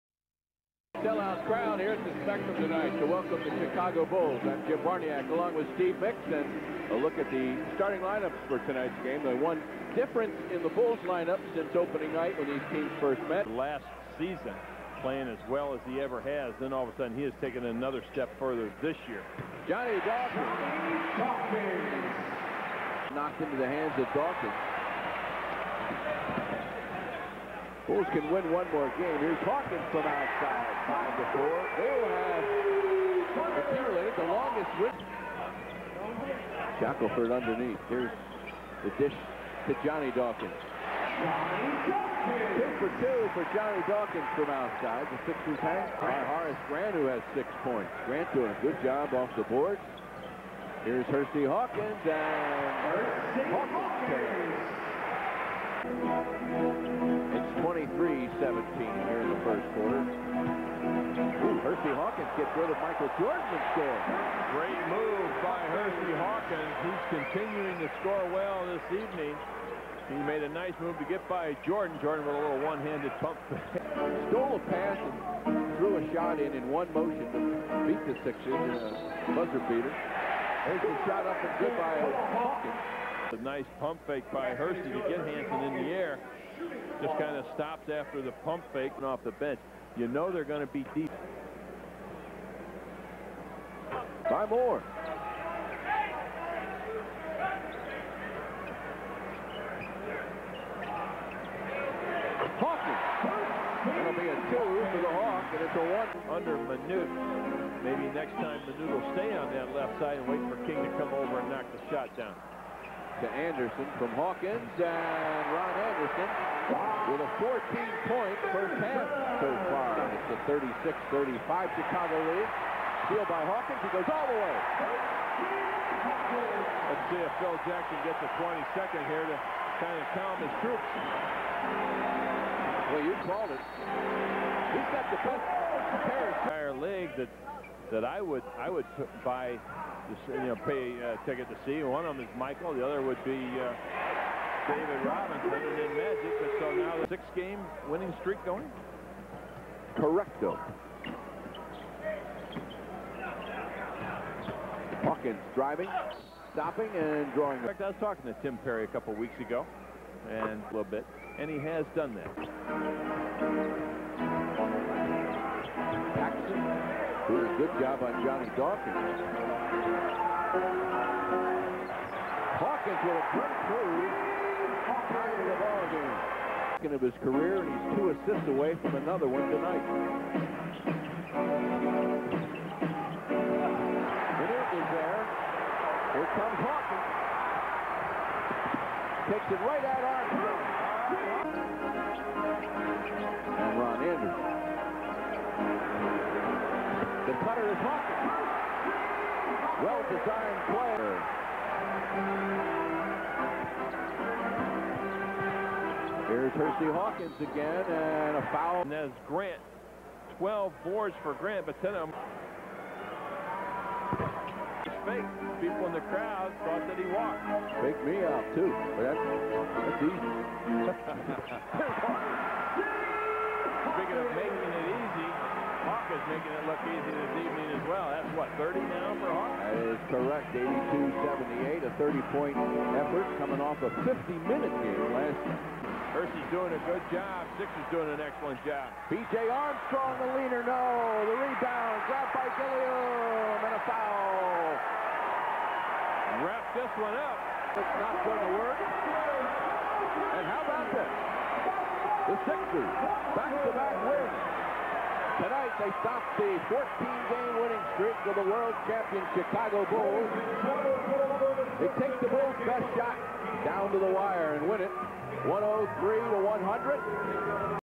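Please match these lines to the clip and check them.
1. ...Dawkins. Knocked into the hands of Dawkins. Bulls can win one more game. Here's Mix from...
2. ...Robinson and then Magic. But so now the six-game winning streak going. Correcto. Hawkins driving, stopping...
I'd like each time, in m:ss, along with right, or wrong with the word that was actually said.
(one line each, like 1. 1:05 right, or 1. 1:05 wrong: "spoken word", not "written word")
1. 0:20 wrong: "Hawkins", not "Mix"
2. 2:25 right.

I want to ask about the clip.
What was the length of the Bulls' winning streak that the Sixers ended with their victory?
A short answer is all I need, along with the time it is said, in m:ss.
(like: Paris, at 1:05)
14 games, at 4:16.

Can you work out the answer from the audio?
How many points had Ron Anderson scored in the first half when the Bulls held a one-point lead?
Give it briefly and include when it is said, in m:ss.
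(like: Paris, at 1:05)
14, at 1:57.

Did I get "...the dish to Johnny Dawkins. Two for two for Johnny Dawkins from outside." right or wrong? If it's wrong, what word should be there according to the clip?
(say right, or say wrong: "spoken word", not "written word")
right.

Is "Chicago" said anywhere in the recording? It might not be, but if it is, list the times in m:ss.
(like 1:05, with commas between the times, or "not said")
0:03, 2:01, 4:19.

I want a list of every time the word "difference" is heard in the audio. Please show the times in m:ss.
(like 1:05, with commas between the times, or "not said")
0:09.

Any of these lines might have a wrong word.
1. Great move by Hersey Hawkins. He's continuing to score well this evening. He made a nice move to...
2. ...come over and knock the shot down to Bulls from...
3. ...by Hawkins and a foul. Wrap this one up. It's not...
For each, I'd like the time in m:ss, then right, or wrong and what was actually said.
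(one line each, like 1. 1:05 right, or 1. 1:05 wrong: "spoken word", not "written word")
1. 1:04 right
2. 1:50 wrong: "Anderson", not "Bulls"
3. 4:02 wrong: "Gilliam", not "Hawkins".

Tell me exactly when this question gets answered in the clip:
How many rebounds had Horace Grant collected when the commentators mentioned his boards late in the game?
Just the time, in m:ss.
3:30.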